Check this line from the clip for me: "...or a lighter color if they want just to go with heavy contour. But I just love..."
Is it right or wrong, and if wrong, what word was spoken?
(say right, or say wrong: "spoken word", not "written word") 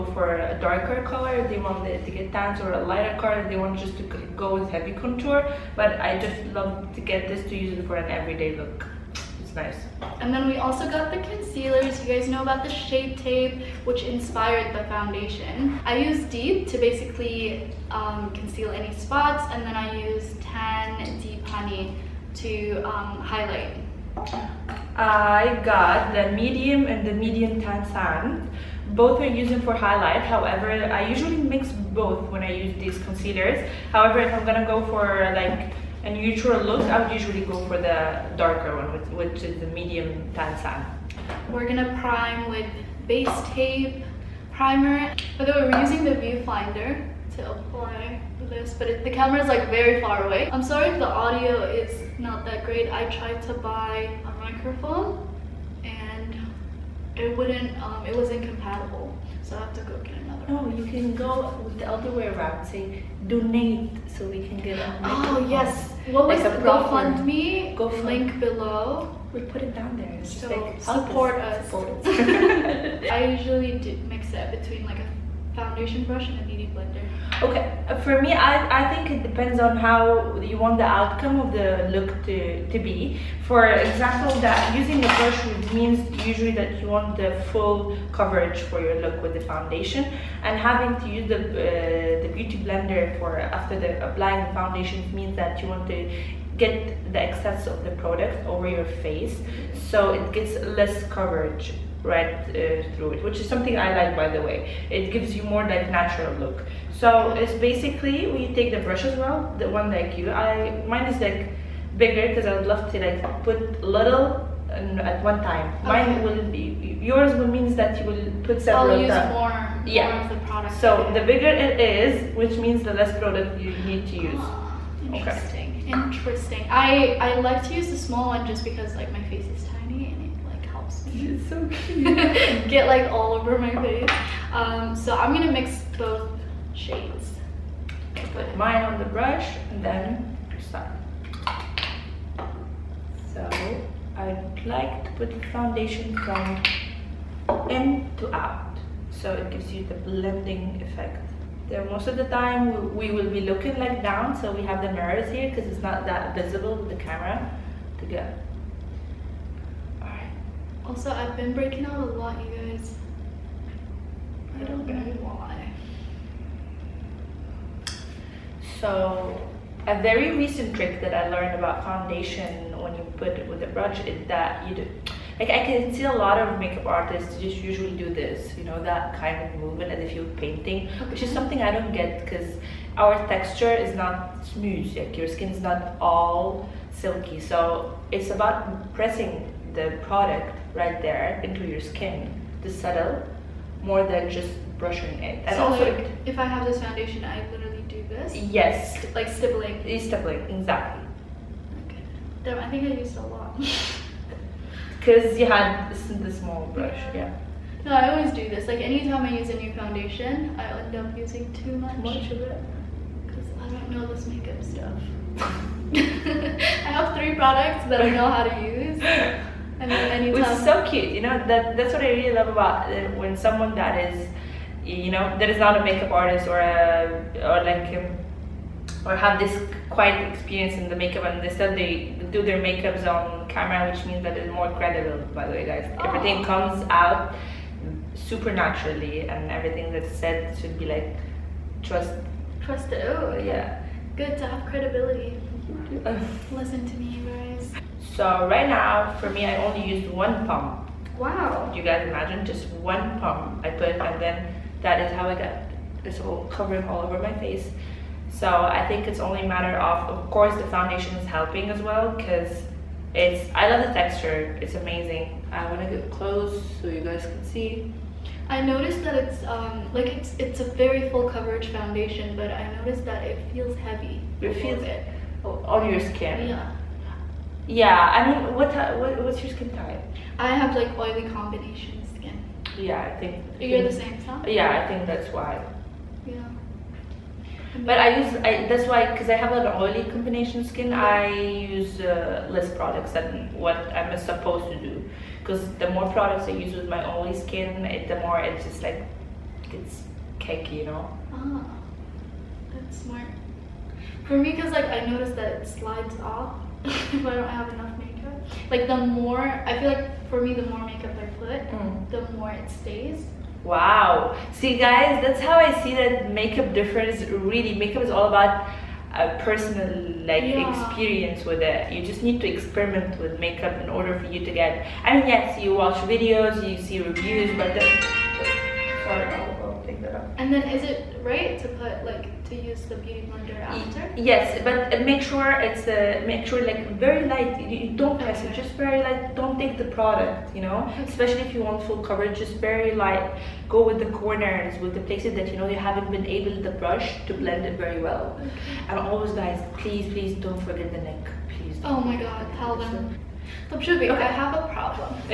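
right.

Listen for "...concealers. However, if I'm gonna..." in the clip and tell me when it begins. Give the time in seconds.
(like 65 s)
33 s.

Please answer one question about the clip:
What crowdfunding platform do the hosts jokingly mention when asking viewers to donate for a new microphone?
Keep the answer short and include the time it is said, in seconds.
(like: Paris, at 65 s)
GoFundMe, at 66 s.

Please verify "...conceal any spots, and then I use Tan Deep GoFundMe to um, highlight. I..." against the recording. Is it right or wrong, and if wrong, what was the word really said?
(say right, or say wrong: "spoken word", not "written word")
wrong: "Honey", not "GoFundMe".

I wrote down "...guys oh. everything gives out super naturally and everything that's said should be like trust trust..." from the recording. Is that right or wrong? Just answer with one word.
wrong.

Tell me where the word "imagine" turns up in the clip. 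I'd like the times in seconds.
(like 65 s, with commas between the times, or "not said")
252 s.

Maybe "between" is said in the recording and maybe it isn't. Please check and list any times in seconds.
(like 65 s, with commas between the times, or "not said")
74 s.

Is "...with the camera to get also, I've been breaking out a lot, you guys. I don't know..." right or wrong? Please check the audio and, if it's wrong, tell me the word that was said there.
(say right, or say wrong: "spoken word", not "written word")
right.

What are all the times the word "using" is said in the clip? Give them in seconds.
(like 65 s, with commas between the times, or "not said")
29 s, 45 s, 84 s, 211 s.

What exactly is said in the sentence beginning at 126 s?
interesting I I like to use the small one just because like my face is tiny and so cute.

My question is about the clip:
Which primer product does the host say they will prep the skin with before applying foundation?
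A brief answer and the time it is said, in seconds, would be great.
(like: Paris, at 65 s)
Base tape primer, at 43 s.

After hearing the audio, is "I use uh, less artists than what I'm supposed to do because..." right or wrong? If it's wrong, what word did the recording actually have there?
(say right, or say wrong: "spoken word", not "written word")
wrong: "products", not "artists".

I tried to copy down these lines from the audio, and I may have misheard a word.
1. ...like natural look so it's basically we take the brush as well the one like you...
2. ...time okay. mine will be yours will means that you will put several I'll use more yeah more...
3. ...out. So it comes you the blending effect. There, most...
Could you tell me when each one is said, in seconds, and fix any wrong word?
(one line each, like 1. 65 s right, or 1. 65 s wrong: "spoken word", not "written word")
1. 105 s right
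2. 115 s right
3. 148 s wrong: "gives", not "comes".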